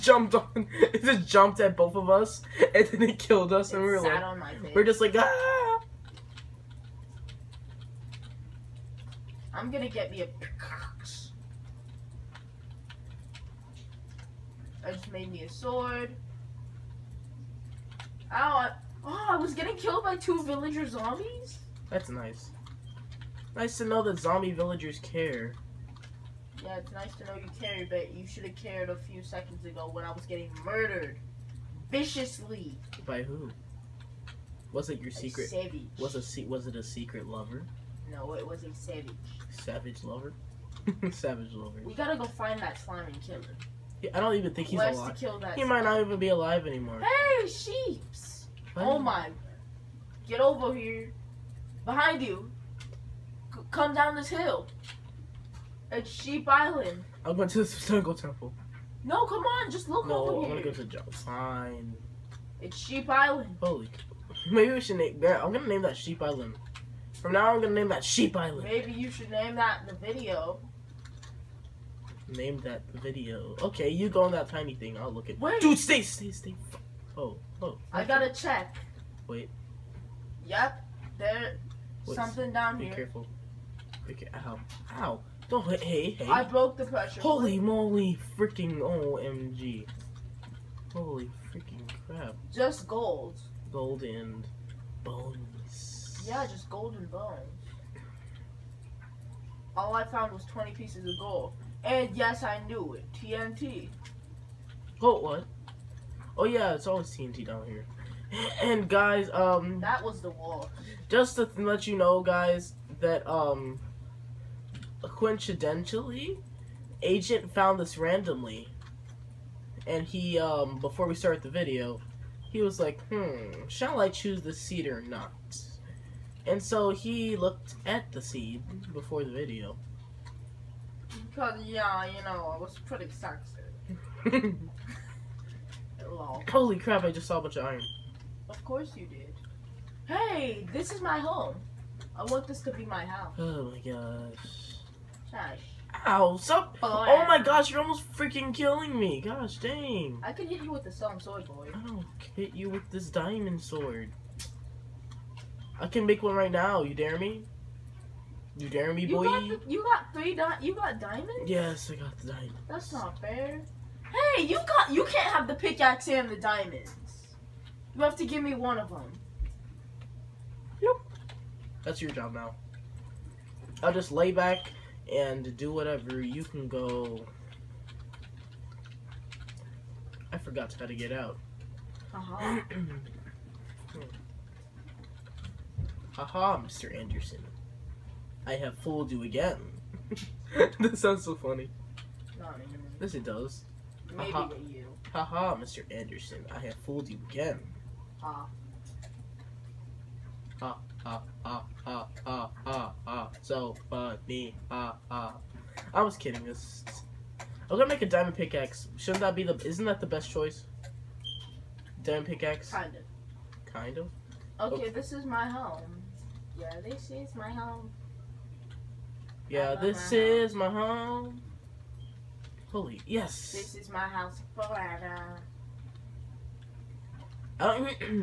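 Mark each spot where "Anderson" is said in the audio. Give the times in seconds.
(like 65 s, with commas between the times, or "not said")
186 s, 196 s.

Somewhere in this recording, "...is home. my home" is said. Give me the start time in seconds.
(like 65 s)
220 s.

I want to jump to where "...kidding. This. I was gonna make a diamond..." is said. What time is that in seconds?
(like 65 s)
206 s.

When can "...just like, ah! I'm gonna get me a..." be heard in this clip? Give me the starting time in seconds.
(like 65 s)
4 s.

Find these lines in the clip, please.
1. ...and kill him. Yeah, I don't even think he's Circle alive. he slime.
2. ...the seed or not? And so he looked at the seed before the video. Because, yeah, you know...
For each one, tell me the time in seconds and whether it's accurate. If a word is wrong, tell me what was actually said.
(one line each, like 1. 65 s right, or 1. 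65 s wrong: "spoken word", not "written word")
1. 43 s wrong: "Kill", not "Circle"
2. 124 s right.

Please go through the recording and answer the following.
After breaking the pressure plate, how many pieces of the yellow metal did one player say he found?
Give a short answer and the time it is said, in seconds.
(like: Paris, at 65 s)
20, at 100 s.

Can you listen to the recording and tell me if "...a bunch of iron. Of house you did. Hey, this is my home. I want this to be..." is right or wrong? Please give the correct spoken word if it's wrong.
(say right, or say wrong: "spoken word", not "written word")
wrong: "course", not "house".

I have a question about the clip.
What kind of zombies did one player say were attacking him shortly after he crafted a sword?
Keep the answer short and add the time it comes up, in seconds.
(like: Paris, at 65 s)
Villager zombies, at 20 s.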